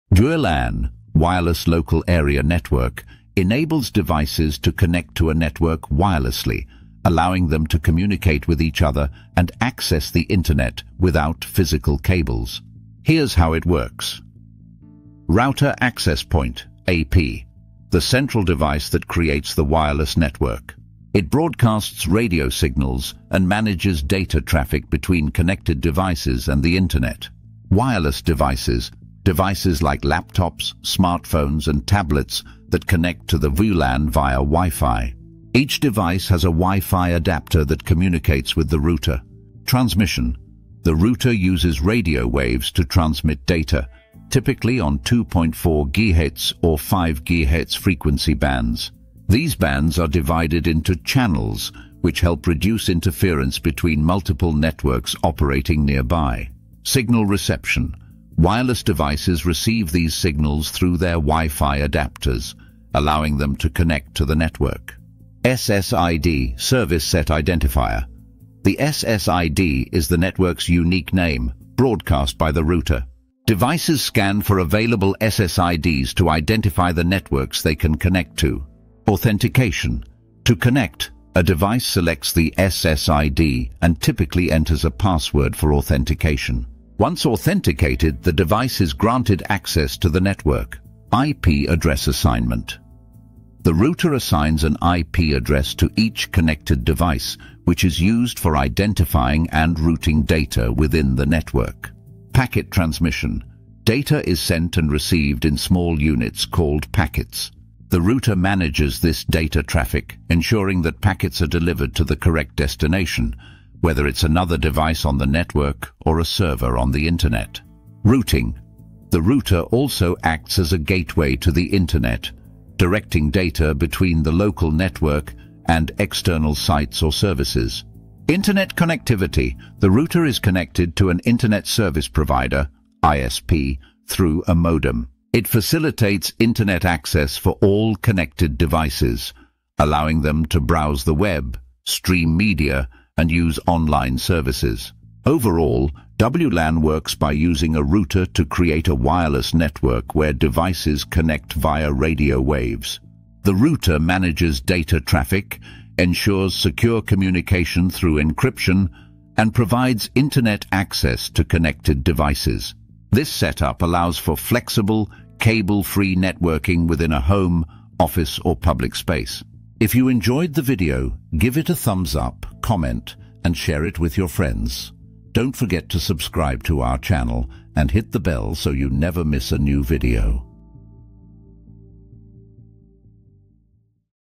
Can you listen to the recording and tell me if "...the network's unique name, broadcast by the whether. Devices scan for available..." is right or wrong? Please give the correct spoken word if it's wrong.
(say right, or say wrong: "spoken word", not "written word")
wrong: "router", not "whether".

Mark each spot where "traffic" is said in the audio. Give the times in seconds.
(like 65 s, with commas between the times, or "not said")
24 s, 109 s, 155 s.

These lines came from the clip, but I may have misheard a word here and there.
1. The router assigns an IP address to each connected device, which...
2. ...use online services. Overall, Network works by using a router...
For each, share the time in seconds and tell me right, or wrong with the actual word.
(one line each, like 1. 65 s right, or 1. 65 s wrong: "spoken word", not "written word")
1. 93 s right
2. 143 s wrong: "WLAN", not "Network".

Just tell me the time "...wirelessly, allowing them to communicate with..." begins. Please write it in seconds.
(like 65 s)
5 s.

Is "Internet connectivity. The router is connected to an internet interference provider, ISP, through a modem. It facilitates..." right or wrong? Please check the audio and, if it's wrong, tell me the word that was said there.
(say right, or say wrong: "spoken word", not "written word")
wrong: "service", not "interference".